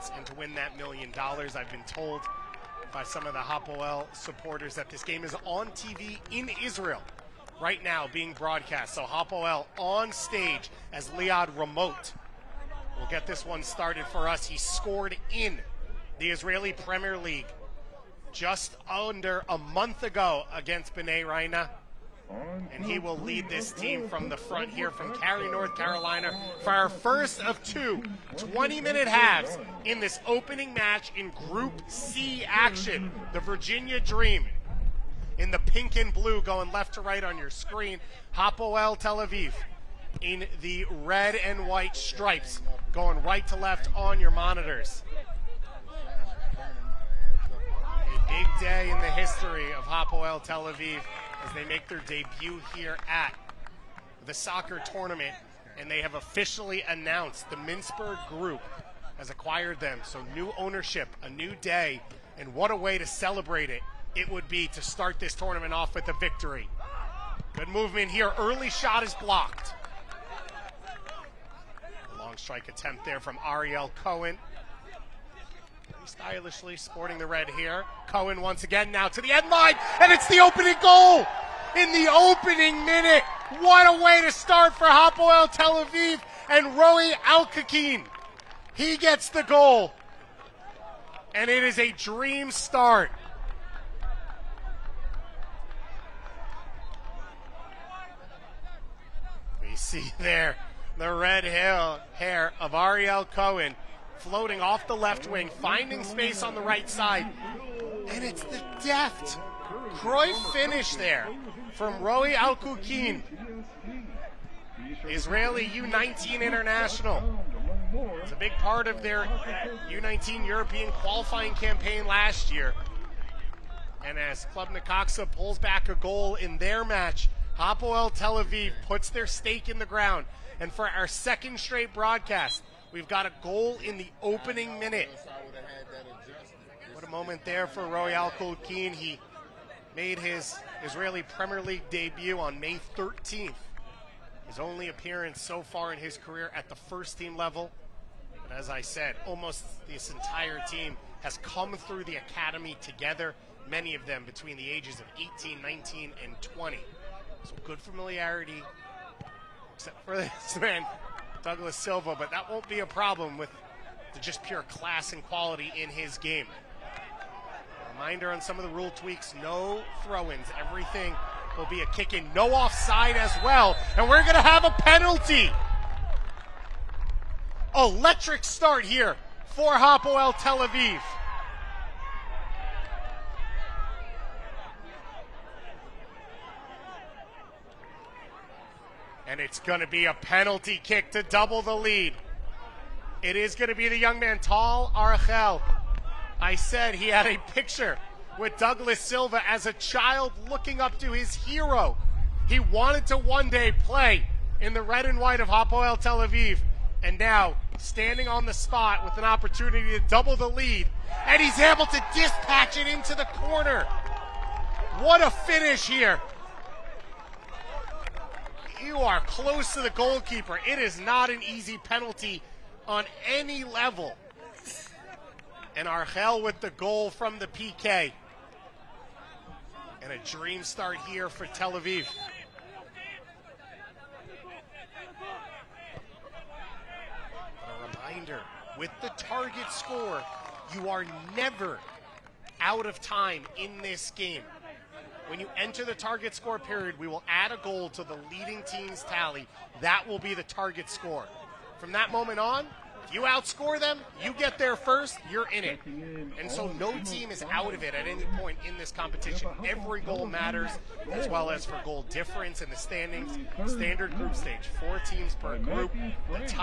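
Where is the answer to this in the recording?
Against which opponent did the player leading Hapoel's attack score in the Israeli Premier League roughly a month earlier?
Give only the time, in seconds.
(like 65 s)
20 s.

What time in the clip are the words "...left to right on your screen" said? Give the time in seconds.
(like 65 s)
36 s.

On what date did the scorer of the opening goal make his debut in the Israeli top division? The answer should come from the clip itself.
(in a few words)
May 13th.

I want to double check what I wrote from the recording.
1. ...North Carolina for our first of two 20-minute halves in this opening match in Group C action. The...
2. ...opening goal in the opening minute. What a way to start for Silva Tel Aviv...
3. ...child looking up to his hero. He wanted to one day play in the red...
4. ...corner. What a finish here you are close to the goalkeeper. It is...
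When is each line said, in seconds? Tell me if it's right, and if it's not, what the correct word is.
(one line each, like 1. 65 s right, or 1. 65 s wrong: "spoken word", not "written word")
1. 25 s right
2. 80 s wrong: "Hapoel", not "Silva"
3. 199 s right
4. 213 s right.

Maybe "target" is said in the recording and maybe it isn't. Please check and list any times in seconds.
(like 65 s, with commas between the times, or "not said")
239 s, 245 s, 250 s.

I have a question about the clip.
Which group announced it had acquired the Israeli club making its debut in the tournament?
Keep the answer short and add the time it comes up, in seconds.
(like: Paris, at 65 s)
Mintzberg Group, at 57 s.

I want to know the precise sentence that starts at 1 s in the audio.
I've been told by some of the Hapoel supporters that this game is on TV in Israel right now being broadcast.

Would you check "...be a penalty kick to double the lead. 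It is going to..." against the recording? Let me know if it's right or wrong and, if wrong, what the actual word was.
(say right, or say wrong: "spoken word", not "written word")
right.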